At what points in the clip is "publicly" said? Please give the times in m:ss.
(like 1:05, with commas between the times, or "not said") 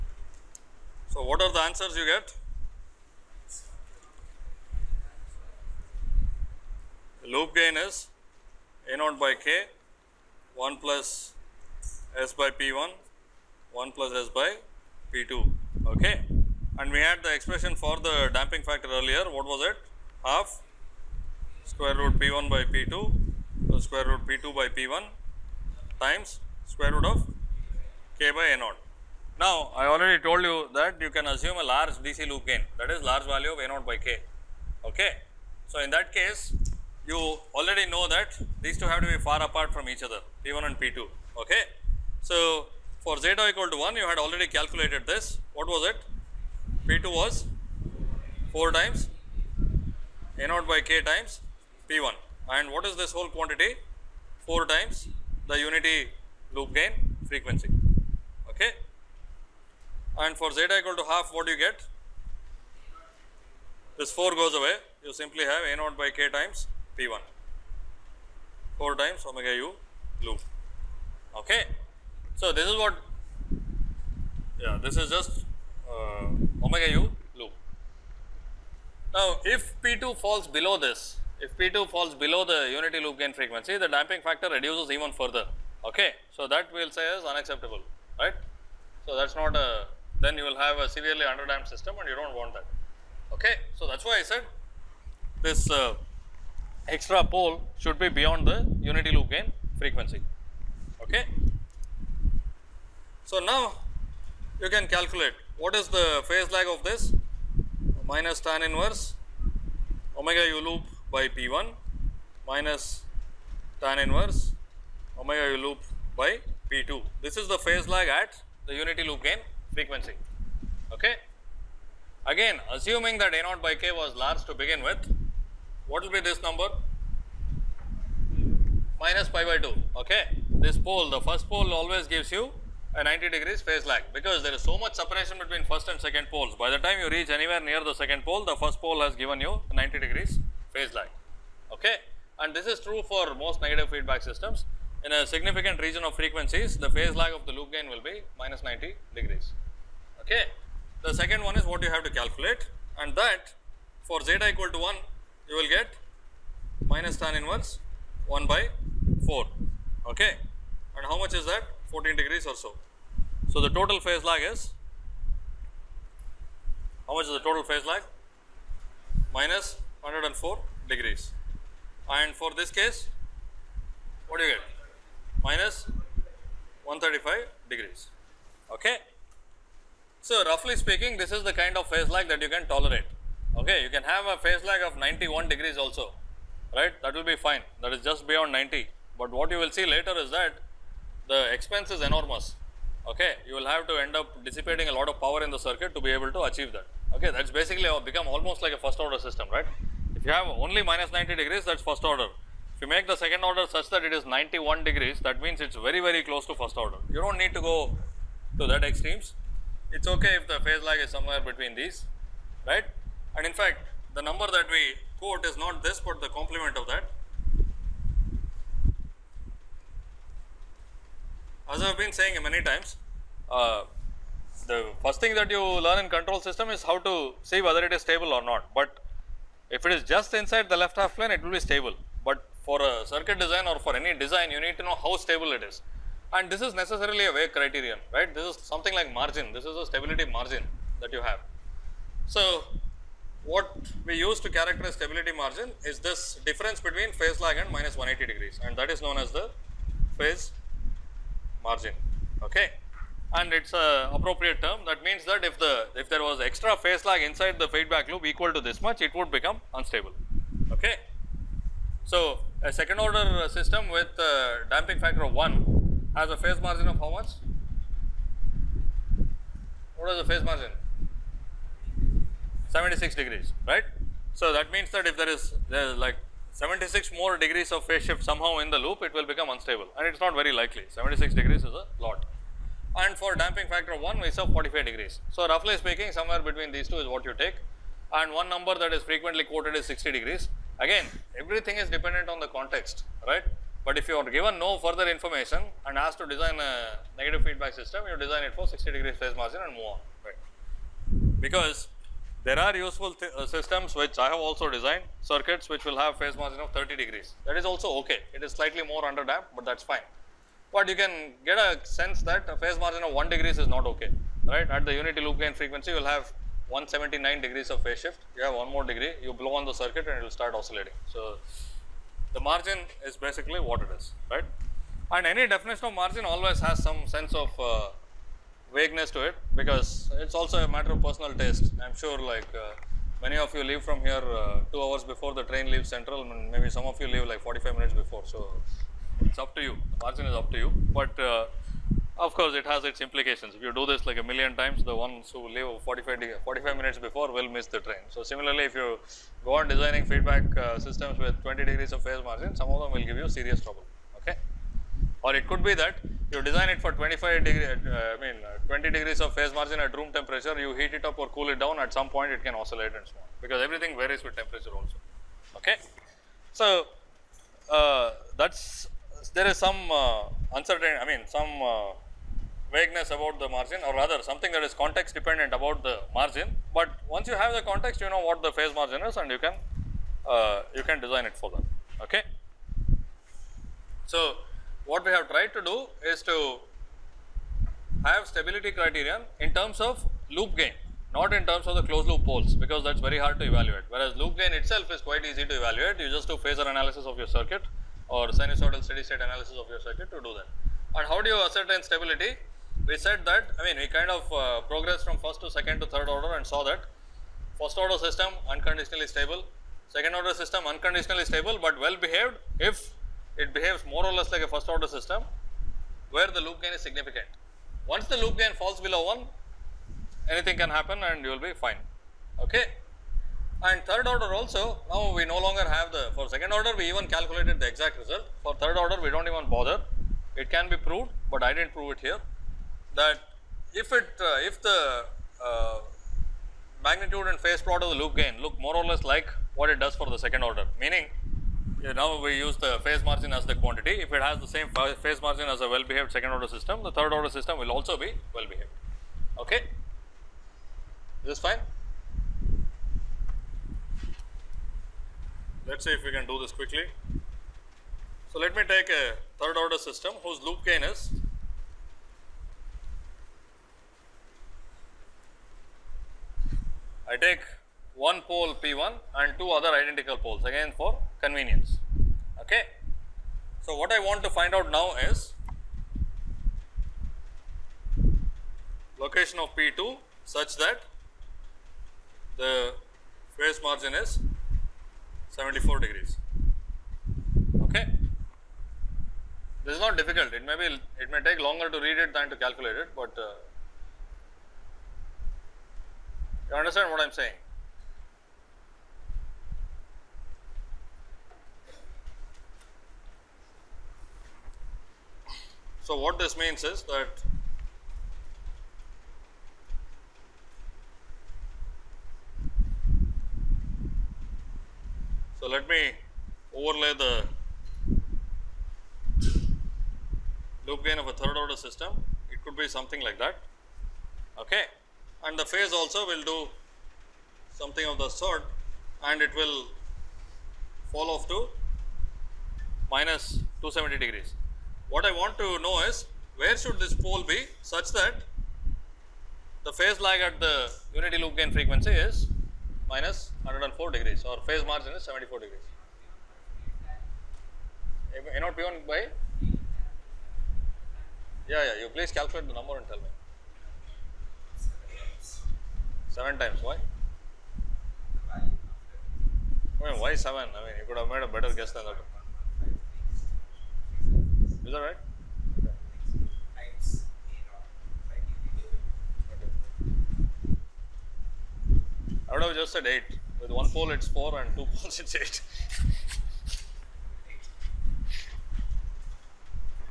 not said.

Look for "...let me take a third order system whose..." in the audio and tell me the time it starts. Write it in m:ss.
7:38.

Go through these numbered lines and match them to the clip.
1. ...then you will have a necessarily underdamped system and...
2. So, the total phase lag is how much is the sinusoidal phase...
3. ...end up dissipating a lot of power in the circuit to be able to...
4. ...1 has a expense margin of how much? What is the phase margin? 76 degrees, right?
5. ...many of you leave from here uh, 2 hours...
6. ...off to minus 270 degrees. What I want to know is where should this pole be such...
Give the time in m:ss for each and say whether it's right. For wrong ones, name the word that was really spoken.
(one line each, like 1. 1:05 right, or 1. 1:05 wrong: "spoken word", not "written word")
1. 1:30 wrong: "severely", not "necessarily"
2. 2:43 wrong: "total", not "sinusoidal"
3. 3:14 right
4. 4:25 wrong: "phase", not "expense"
5. 5:33 right
6. 8:51 right.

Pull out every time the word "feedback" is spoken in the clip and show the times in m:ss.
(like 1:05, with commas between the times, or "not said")
2:23, 4:17, 4:57, 5:50.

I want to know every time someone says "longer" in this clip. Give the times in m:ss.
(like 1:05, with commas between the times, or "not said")
7:05, 8:11.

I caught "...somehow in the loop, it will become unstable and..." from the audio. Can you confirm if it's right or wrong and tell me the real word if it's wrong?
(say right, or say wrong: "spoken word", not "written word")
right.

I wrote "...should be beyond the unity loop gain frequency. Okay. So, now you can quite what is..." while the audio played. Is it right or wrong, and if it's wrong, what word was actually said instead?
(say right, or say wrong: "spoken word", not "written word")
wrong: "calculate", not "quite".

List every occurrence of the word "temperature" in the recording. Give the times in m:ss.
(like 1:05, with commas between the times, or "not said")
6:00, 6:04.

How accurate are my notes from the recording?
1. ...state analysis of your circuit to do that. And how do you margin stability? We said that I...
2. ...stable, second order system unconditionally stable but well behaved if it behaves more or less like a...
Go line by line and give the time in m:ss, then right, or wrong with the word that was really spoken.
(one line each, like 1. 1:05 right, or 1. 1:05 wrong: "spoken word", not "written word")
1. 6:39 wrong: "ascertain", not "margin"
2. 6:49 right.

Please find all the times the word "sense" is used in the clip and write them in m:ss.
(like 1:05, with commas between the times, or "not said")
5:11, 5:27.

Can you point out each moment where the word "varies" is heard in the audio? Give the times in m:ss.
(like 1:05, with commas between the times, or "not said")
6:03.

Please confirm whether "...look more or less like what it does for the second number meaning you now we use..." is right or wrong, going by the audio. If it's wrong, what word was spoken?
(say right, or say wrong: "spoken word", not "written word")
wrong: "order", not "number".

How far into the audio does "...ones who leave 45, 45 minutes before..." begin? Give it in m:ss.
5:44.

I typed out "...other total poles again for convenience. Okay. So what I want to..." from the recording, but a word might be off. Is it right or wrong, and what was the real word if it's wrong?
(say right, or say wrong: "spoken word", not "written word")
wrong: "identical", not "total".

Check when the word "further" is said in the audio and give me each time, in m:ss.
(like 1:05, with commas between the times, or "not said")
1:25, 4:54.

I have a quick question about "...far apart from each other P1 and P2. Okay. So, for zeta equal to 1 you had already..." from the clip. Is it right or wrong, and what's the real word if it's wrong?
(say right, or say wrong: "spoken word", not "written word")
right.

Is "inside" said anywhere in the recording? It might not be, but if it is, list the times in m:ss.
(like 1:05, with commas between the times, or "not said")
3:50, 4:17.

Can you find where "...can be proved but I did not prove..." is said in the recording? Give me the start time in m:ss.
7:10.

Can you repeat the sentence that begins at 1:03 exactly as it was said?
This 4 goes away you simply have a naught by k times p1 4 times omega u loop.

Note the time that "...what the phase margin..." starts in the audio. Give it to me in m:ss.
6:18.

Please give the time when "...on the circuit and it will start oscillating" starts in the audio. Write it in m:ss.
5:19.